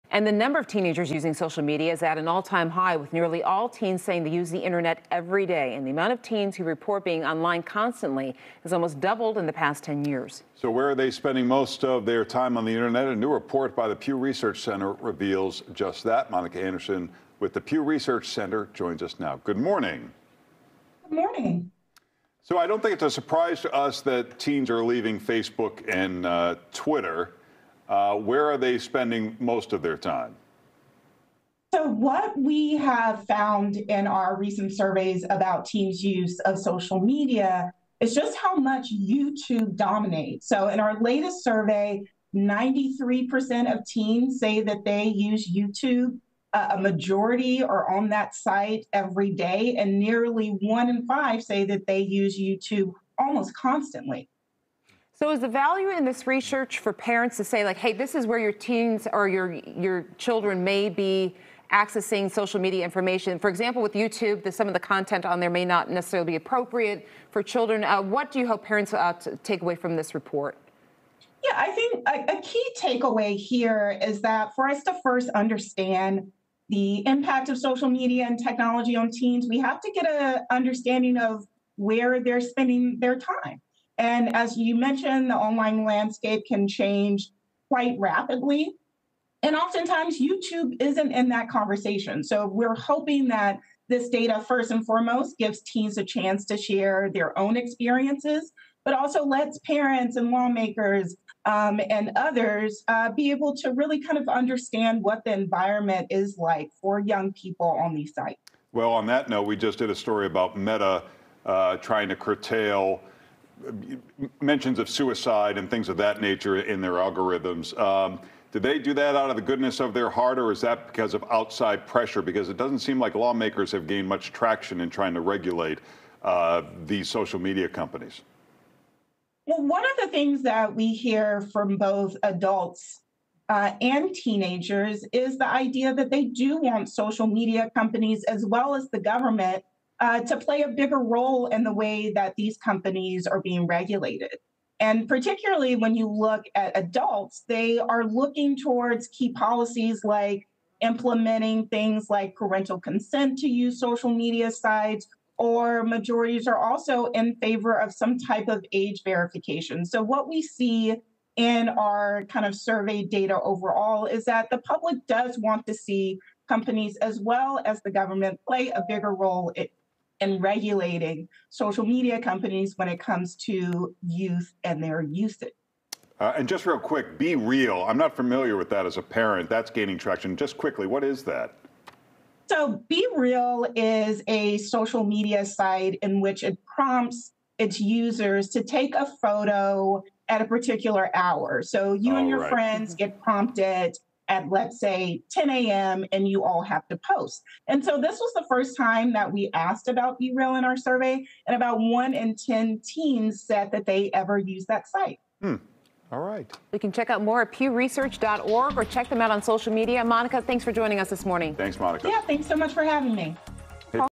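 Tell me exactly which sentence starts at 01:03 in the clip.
For example, with YouTube, the, some of the content on there may not necessarily be appropriate for children.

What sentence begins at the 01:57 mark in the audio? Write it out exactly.
Um, do they do that out of the goodness of their heart, or is that because of outside pressure?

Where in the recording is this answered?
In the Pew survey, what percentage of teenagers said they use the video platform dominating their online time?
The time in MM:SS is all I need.
00:42.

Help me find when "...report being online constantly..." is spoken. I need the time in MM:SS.
00:06.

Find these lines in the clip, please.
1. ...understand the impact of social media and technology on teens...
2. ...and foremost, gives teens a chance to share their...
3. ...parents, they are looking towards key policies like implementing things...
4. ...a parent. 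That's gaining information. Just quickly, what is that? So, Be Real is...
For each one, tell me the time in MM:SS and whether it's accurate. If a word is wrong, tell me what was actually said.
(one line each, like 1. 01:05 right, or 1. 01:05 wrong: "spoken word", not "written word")
1. 01:15 right
2. 01:34 right
3. 02:26 wrong: "adults", not "parents"
4. 02:58 wrong: "traction", not "information".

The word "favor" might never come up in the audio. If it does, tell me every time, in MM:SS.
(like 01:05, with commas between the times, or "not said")
02:37.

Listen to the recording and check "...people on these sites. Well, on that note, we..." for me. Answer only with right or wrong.
right.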